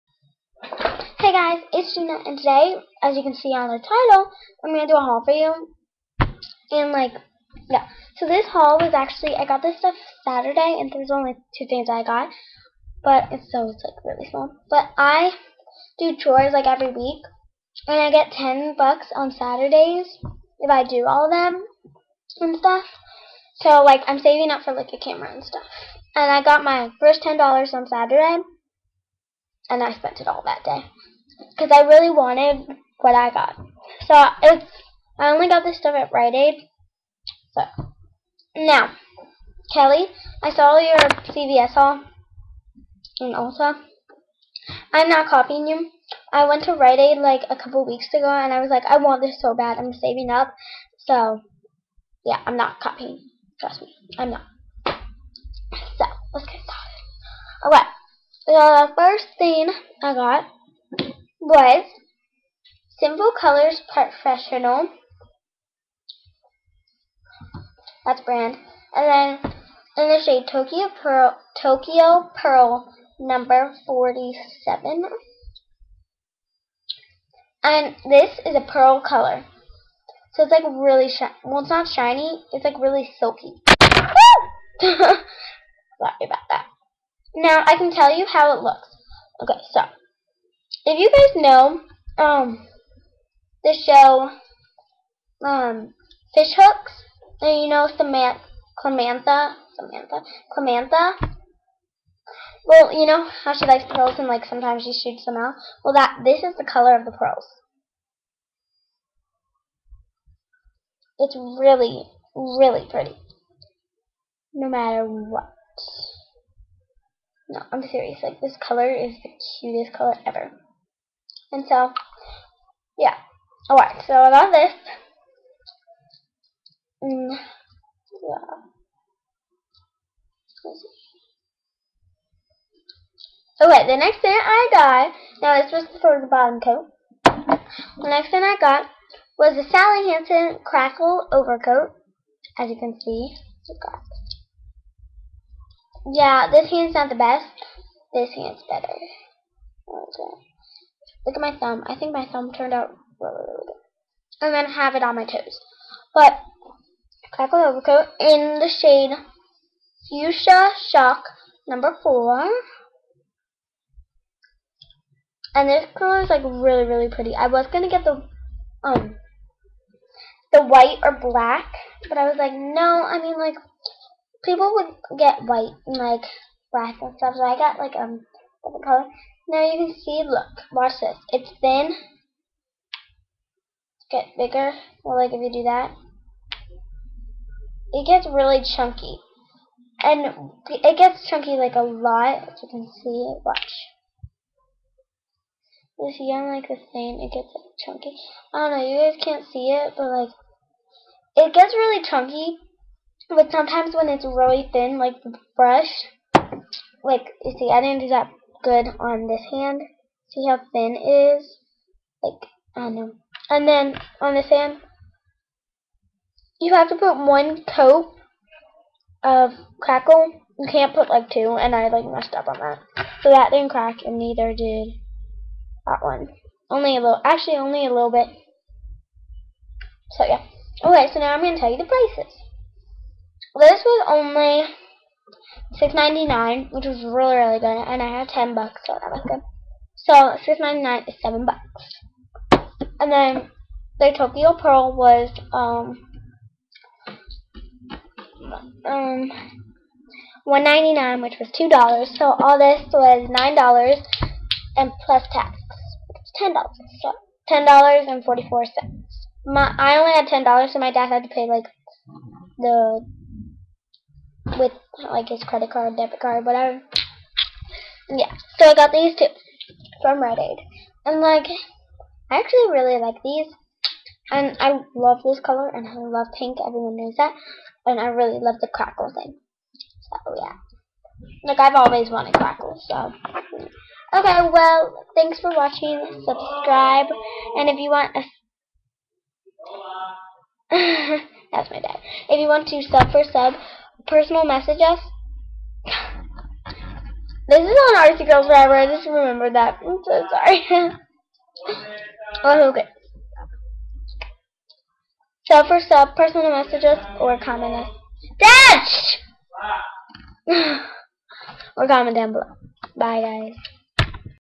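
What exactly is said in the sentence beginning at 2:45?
And this color is like really, really pretty.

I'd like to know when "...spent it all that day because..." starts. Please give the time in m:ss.
0:29.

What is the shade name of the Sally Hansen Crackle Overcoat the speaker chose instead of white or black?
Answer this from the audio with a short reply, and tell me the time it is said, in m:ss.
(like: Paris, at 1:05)
Fuchsia Shock, at 2:40.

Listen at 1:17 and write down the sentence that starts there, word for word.
And this is a pearl color.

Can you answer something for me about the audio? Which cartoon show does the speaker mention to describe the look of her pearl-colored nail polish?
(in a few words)
Fish Hooks.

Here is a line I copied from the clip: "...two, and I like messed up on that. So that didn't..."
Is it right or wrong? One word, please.
right.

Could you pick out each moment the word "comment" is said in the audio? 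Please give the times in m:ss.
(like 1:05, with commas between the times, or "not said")
5:07, 5:11.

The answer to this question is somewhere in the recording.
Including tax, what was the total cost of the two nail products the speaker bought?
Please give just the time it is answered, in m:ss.
4:17.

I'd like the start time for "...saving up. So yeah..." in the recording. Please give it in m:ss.
0:49.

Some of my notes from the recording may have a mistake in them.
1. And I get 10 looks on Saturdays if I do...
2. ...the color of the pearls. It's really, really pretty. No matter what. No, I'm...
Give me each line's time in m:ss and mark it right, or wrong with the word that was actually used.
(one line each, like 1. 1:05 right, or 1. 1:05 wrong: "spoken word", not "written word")
1. 0:17 wrong: "bucks", not "looks"
2. 1:46 right.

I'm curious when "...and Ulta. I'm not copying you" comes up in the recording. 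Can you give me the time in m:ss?
0:43.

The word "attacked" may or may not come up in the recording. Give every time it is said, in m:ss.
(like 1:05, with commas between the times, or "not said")
not said.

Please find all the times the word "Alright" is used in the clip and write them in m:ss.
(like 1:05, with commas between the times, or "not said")
0:57, 2:03.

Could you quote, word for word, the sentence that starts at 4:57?
this is on Artsy Girls Forever.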